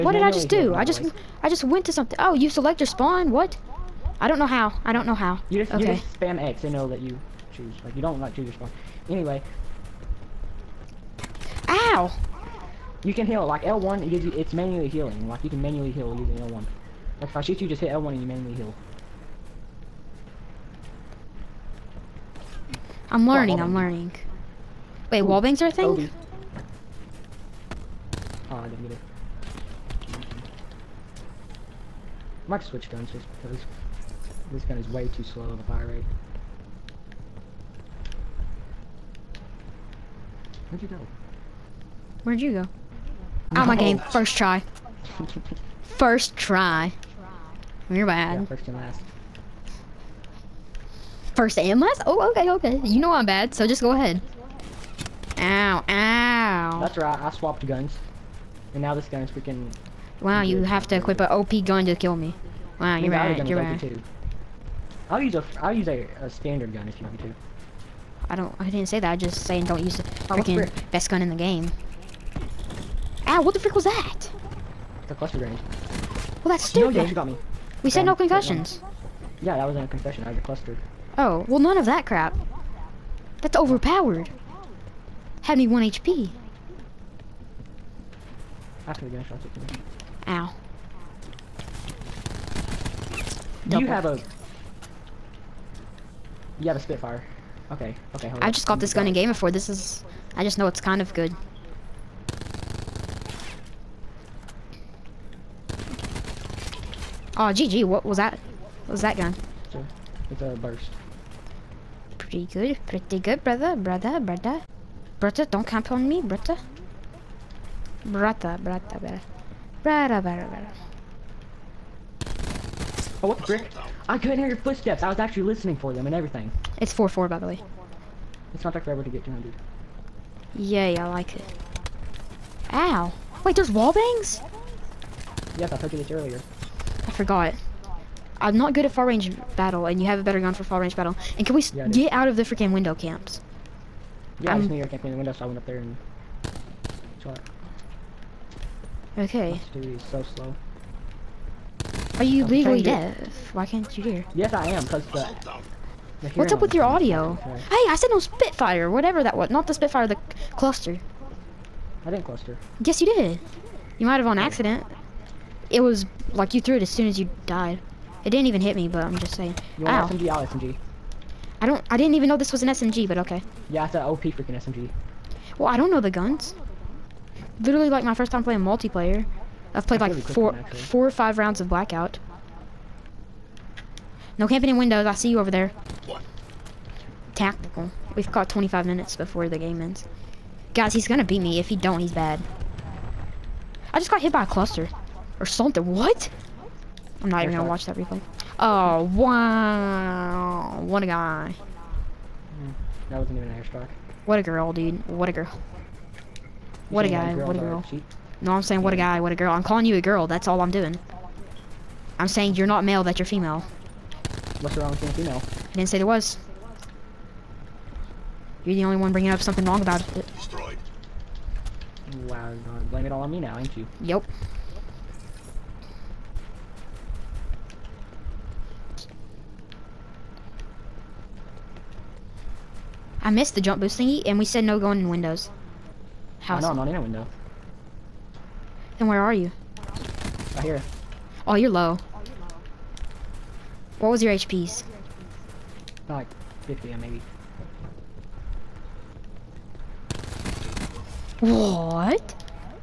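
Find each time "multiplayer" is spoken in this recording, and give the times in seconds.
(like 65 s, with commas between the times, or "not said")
178 s.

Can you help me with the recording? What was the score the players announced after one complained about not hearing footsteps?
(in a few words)
4-4.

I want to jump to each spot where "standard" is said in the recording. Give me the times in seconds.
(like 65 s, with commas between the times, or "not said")
66 s.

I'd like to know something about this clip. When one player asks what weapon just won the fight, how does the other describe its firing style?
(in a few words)
Burst.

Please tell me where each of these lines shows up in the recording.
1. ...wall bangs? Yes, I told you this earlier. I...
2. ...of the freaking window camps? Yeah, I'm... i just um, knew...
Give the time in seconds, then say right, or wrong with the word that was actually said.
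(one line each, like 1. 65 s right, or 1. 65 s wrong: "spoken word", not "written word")
1. 133 s right
2. 142 s right.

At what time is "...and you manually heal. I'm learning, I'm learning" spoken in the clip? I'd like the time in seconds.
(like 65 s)
18 s.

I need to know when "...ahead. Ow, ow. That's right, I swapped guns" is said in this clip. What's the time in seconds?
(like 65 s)
53 s.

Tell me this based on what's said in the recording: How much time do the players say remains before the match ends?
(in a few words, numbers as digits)
25 minutes.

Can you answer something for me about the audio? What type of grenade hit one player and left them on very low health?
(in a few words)
Cluster grenade.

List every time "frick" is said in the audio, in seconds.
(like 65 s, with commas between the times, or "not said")
73 s, 123 s.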